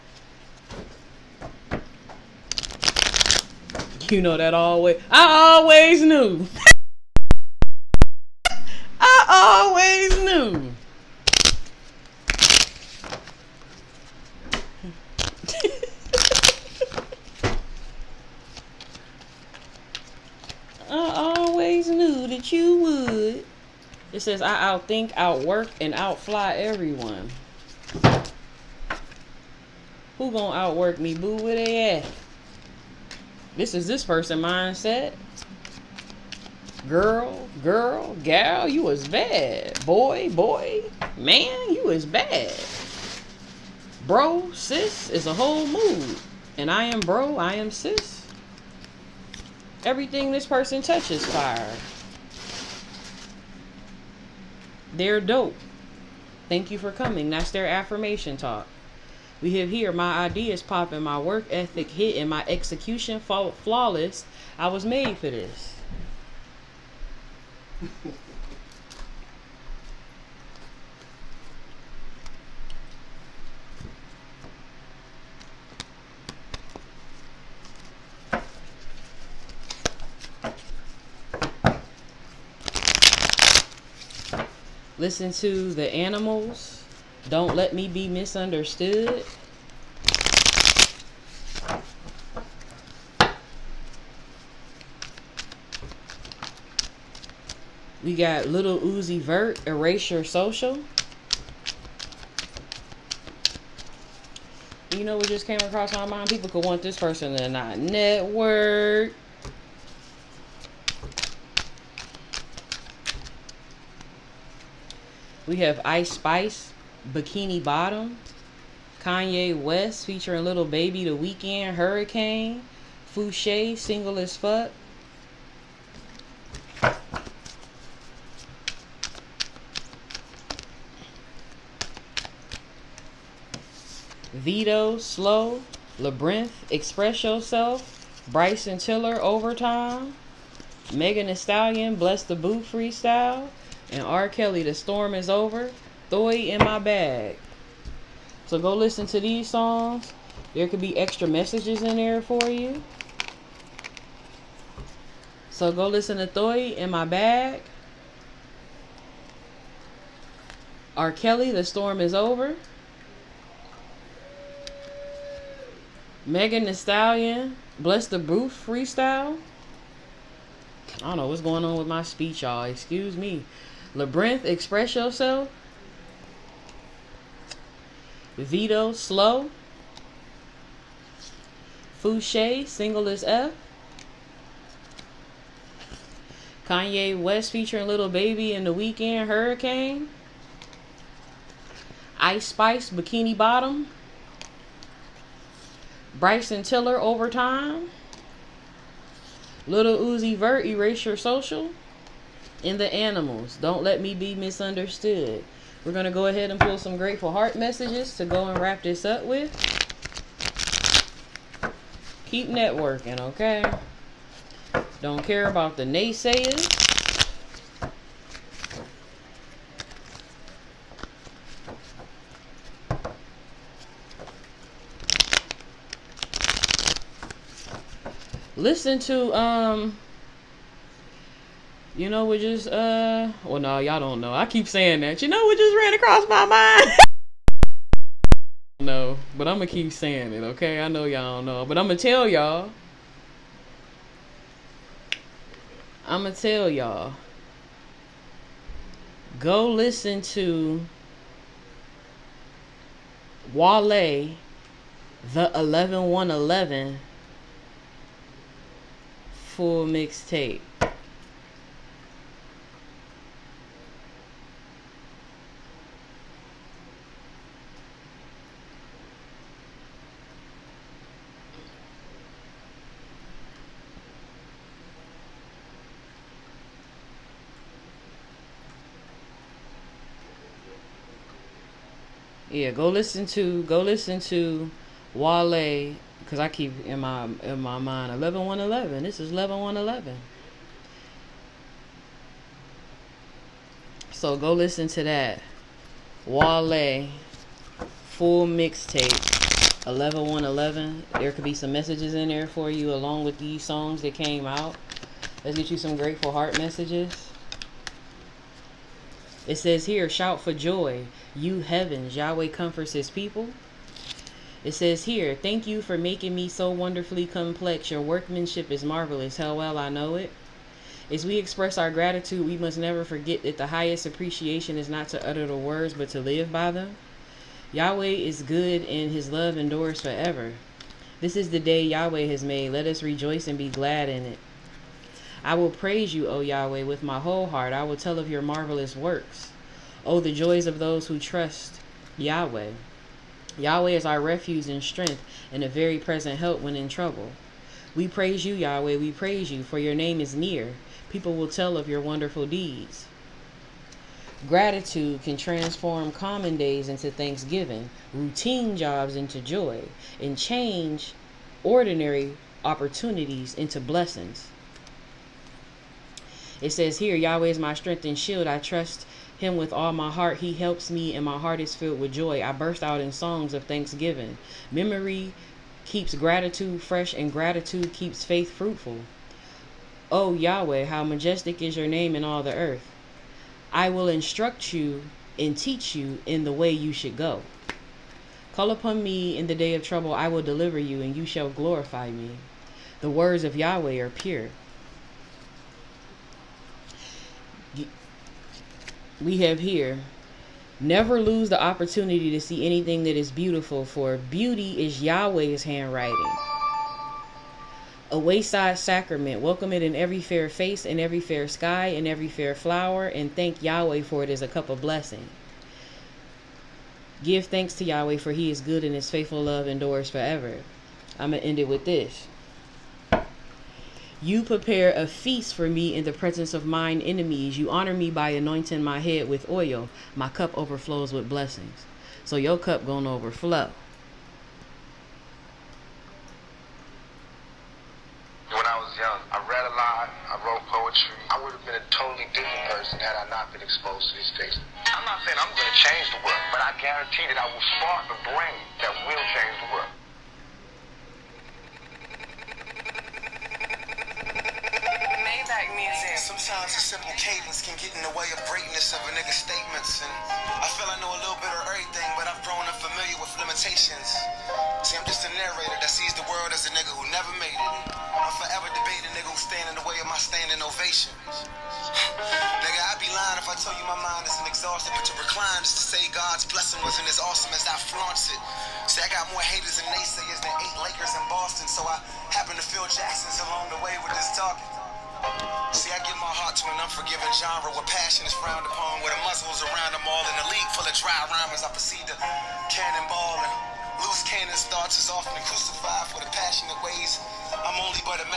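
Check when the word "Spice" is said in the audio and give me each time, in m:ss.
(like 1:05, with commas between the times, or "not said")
1:56, 3:12.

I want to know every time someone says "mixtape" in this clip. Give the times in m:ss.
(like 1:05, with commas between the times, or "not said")
4:19, 4:58.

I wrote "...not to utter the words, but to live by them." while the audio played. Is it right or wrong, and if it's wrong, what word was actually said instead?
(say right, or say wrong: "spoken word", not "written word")
right.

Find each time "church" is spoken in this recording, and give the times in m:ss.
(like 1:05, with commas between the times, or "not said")
not said.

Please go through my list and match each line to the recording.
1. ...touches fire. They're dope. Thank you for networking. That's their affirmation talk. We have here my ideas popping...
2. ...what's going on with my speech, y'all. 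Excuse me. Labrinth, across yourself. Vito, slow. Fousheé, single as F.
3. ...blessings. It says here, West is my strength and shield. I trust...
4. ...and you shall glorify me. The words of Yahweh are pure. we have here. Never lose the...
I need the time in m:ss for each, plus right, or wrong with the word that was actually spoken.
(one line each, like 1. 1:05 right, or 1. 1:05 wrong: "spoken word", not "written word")
1. 0:50 wrong: "coming", not "networking"
2. 2:51 wrong: "express", not "across"
3. 6:03 wrong: "Yahweh", not "West"
4. 6:31 right.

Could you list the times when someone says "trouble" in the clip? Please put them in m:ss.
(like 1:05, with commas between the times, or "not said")
5:46, 6:29.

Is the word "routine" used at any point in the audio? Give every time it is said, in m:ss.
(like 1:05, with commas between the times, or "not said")
5:58.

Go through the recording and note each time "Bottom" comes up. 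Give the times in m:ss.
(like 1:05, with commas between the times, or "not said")
1:57, 3:13.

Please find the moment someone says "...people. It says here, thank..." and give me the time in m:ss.
5:13.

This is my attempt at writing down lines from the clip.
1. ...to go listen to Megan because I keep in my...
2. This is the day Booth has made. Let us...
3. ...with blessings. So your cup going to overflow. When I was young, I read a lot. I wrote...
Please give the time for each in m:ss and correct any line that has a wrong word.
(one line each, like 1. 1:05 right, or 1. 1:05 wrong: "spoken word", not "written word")
1. 4:43 wrong: "Wale", not "Megan"
2. 5:31 wrong: "Yahweh", not "Booth"
3. 7:11 right.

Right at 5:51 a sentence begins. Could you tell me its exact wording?
People will tell of your wonderful deeds.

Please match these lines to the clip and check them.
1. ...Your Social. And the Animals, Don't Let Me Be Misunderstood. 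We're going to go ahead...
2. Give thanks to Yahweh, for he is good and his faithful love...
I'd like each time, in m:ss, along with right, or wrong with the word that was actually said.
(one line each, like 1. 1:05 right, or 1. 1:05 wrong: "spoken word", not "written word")
1. 3:21 right
2. 6:57 right.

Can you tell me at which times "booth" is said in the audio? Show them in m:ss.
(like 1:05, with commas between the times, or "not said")
2:22, 2:48.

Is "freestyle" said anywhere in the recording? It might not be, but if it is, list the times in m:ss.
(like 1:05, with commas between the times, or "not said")
2:22, 2:48.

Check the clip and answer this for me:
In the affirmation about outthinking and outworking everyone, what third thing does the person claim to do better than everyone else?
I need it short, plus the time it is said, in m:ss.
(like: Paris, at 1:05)
Outfly, at 0:25.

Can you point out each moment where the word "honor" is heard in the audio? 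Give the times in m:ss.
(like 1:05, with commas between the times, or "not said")
7:07.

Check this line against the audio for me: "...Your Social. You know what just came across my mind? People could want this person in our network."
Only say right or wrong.
right.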